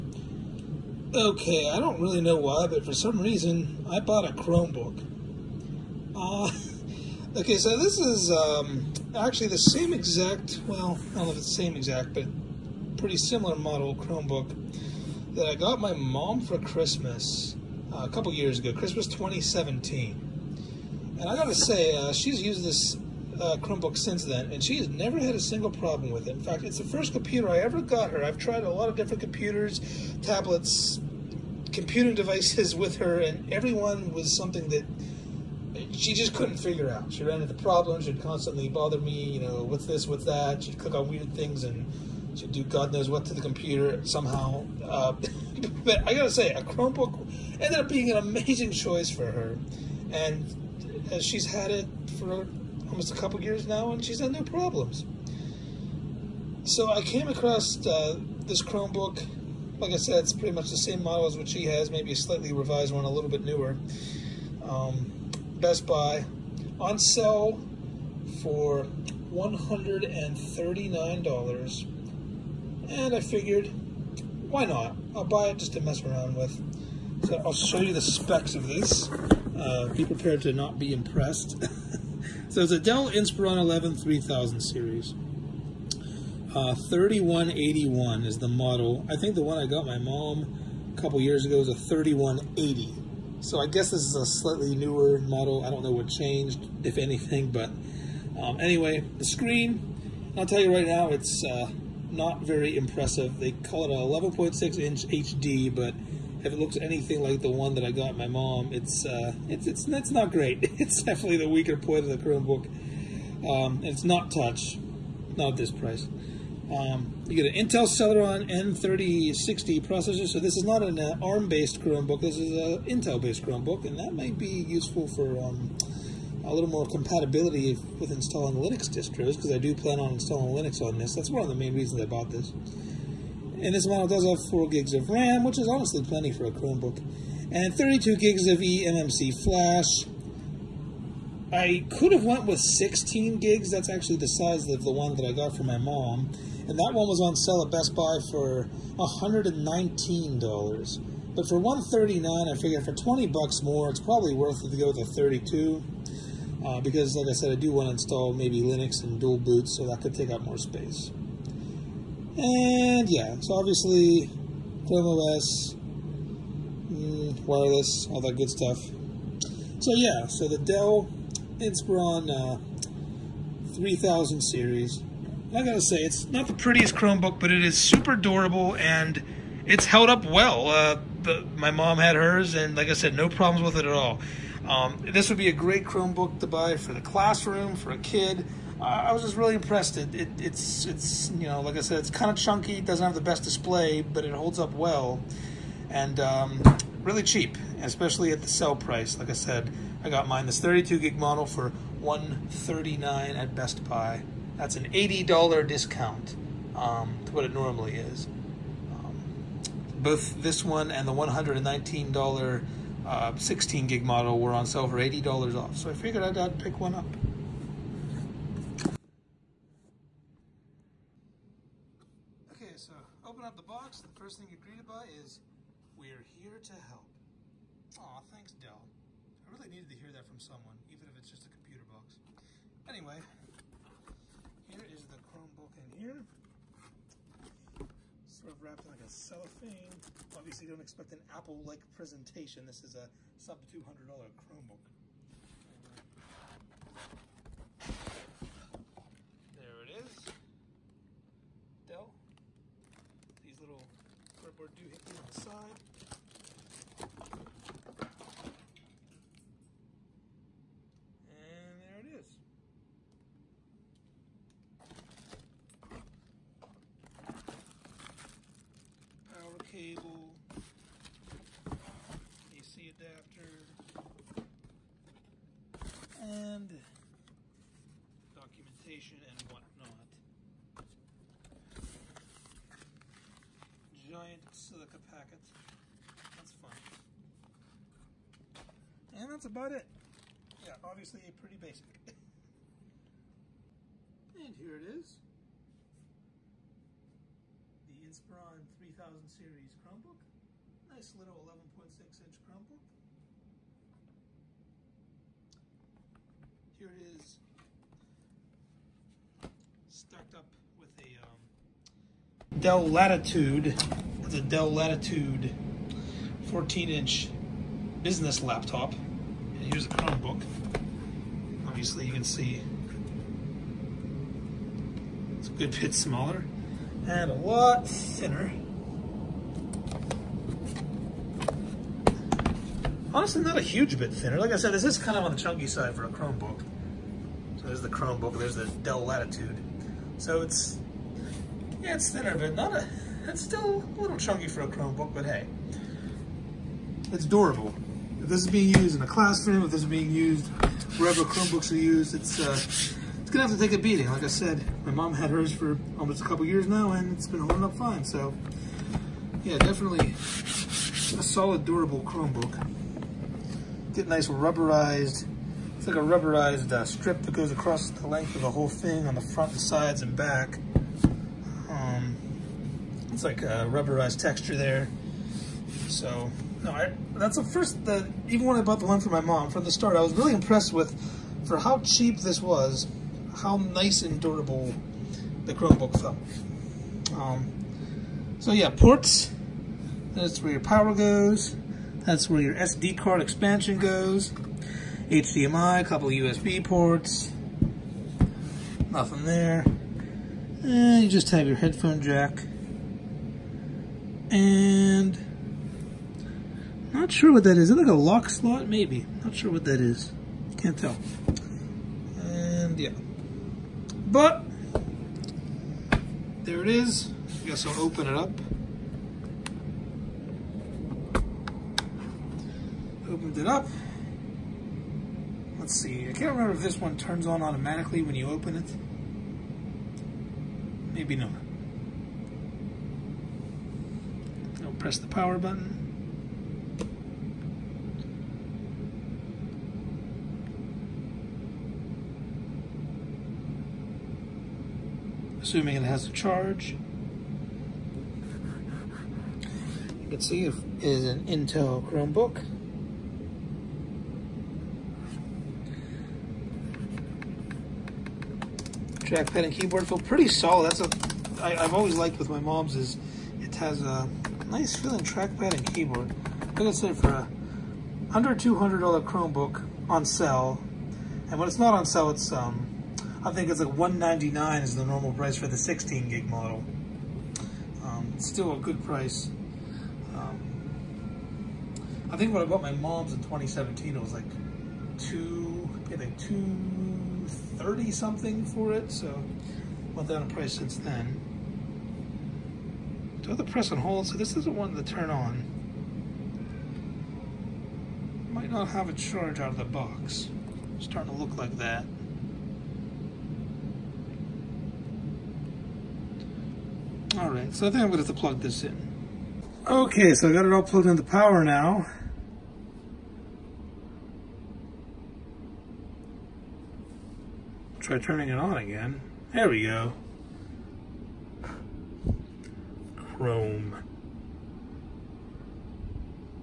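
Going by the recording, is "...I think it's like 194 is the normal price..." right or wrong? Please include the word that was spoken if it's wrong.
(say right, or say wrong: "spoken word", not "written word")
wrong: "199", not "194".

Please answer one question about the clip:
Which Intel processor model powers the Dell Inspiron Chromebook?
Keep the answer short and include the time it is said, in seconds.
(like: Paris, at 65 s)
Intel Celeron N3060, at 117 s.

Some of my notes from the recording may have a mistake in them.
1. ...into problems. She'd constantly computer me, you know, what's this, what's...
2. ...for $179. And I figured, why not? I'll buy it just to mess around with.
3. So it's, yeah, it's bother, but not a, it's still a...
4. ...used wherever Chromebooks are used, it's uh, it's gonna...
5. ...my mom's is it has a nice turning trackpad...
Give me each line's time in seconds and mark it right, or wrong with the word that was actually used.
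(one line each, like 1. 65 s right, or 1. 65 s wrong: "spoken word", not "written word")
1. 37 s wrong: "bother", not "computer"
2. 68 s wrong: "139", not "179"
3. 340 s wrong: "thinner", not "bother"
4. 350 s right
5. 462 s wrong: "feeling", not "turning".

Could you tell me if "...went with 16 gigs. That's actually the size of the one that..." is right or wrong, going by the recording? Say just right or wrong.
right.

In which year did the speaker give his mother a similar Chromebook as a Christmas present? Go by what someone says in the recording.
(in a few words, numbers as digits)
2017.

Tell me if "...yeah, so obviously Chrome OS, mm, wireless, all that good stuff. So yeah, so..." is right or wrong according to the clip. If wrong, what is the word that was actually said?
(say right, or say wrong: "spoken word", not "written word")
right.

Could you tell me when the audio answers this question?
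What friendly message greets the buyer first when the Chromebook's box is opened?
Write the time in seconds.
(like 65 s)
225 s.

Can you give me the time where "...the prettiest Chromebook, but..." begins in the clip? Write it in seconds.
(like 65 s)
176 s.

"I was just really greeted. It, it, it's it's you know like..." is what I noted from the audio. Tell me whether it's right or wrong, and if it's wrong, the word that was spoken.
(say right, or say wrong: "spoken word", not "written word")
wrong: "impressed", not "greeted".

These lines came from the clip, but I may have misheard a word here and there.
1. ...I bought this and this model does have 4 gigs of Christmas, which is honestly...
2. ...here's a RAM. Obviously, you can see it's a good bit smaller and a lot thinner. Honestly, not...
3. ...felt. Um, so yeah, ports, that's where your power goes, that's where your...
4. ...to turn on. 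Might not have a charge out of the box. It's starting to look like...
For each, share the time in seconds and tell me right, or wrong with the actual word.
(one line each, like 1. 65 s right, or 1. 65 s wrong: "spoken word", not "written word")
1. 131 s wrong: "RAM", not "Christmas"
2. 319 s wrong: "Chromebook", not "RAM"
3. 385 s right
4. 494 s right.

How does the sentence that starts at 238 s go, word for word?
Sort of wrapped in like a cellophane.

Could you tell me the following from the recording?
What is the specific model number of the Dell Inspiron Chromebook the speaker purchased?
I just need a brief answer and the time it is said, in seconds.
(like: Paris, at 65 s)
3181, at 86 s.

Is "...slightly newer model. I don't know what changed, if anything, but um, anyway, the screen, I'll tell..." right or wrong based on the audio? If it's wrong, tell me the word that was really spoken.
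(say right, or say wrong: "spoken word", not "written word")
right.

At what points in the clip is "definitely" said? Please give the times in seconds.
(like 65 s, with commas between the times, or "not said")
111 s, 359 s.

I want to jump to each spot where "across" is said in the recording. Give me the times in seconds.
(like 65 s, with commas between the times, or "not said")
57 s, 367 s.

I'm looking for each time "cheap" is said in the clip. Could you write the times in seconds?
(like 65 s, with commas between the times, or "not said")
197 s, 381 s.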